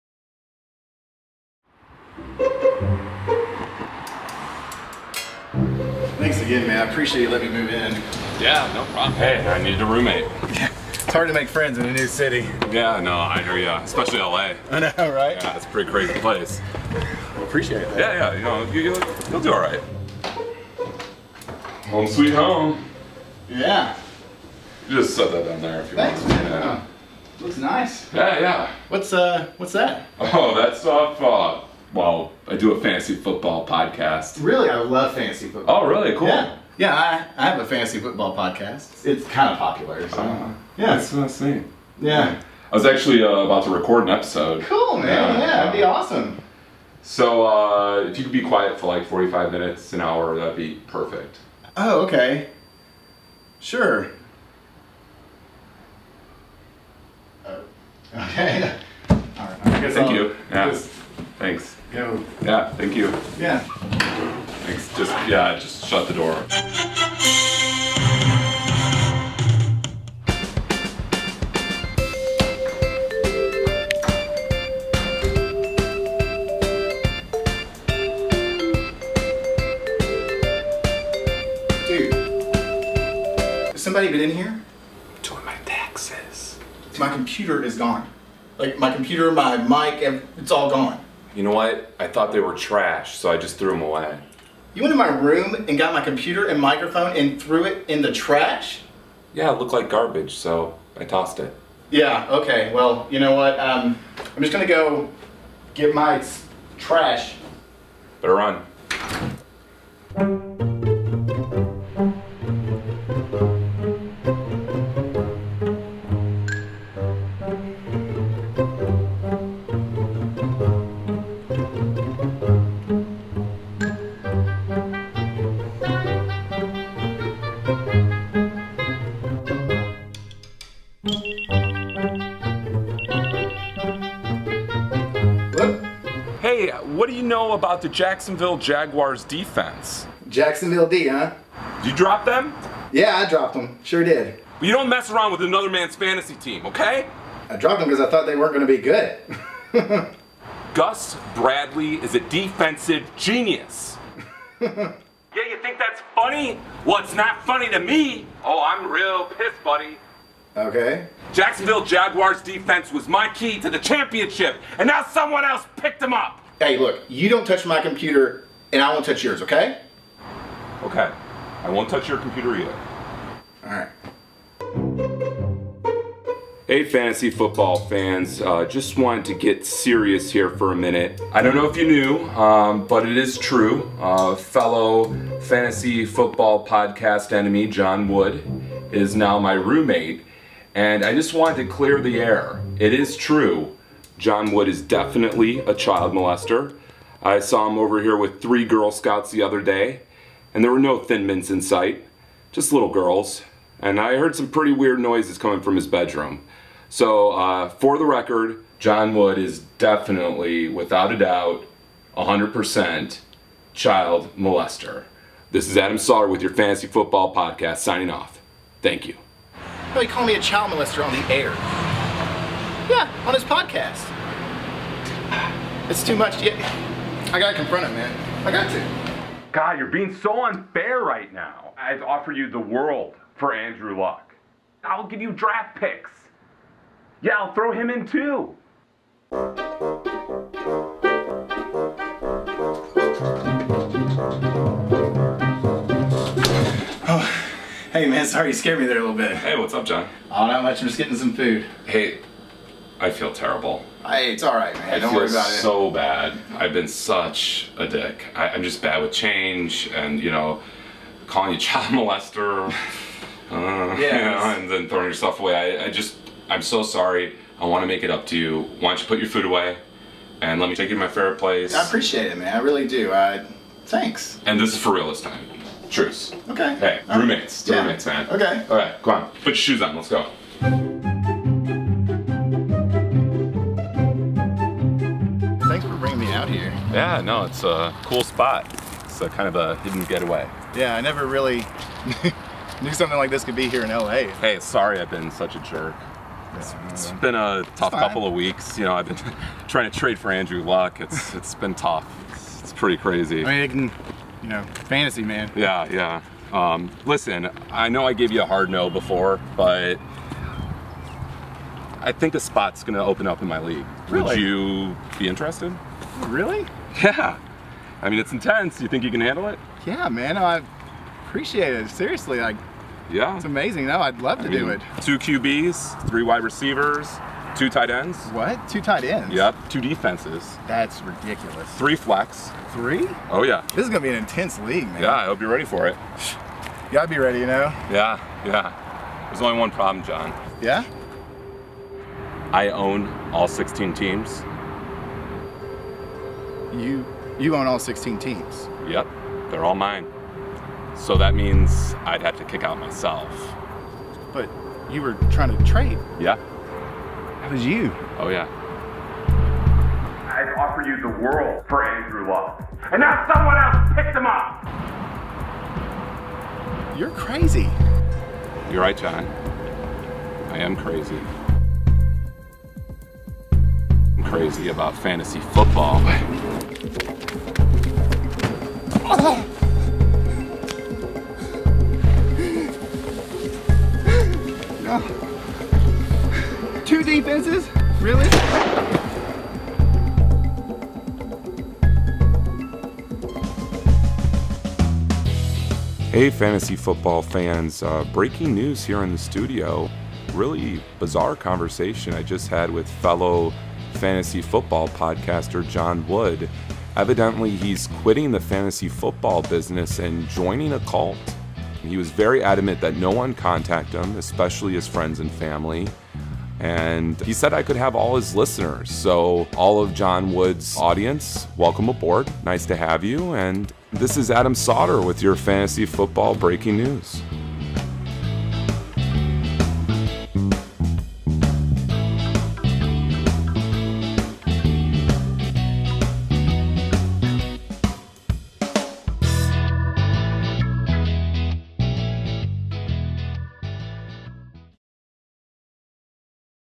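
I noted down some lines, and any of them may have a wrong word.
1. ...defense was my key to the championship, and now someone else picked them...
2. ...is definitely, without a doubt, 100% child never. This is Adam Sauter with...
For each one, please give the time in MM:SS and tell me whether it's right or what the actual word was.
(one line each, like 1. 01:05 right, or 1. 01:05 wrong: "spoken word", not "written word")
1. 02:42 right
2. 03:29 wrong: "molester", not "never".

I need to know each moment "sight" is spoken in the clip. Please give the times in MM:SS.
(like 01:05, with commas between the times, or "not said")
03:21.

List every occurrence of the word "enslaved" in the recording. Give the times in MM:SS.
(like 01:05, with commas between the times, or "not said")
not said.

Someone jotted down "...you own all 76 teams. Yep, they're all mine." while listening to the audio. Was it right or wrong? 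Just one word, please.
wrong.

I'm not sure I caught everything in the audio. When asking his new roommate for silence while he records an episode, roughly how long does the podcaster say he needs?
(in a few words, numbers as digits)
45 minutes.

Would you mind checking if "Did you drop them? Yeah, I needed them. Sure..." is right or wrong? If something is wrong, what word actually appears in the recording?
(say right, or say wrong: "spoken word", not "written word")
wrong: "dropped", not "needed".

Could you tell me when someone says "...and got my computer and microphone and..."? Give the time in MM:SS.
01:35.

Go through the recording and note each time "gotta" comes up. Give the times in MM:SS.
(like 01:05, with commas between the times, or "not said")
03:47, 05:36.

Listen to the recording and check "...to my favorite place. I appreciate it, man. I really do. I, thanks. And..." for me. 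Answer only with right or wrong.
right.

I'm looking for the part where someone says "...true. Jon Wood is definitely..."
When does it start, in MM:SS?
03:13.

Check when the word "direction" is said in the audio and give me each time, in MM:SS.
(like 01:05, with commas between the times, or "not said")
not said.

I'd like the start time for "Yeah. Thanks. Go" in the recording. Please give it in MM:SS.
01:00.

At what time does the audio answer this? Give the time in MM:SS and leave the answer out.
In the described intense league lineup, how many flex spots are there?
05:31.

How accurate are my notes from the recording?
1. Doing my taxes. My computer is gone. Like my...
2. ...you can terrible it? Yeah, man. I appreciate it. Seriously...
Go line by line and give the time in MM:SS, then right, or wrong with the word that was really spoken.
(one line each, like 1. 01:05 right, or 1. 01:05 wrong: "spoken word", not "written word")
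1. 01:25 right
2. 05:19 wrong: "handle", not "terrible".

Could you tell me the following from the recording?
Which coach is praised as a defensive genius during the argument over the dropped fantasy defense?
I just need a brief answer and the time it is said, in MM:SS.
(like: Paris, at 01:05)
Gus Bradley, at 02:30.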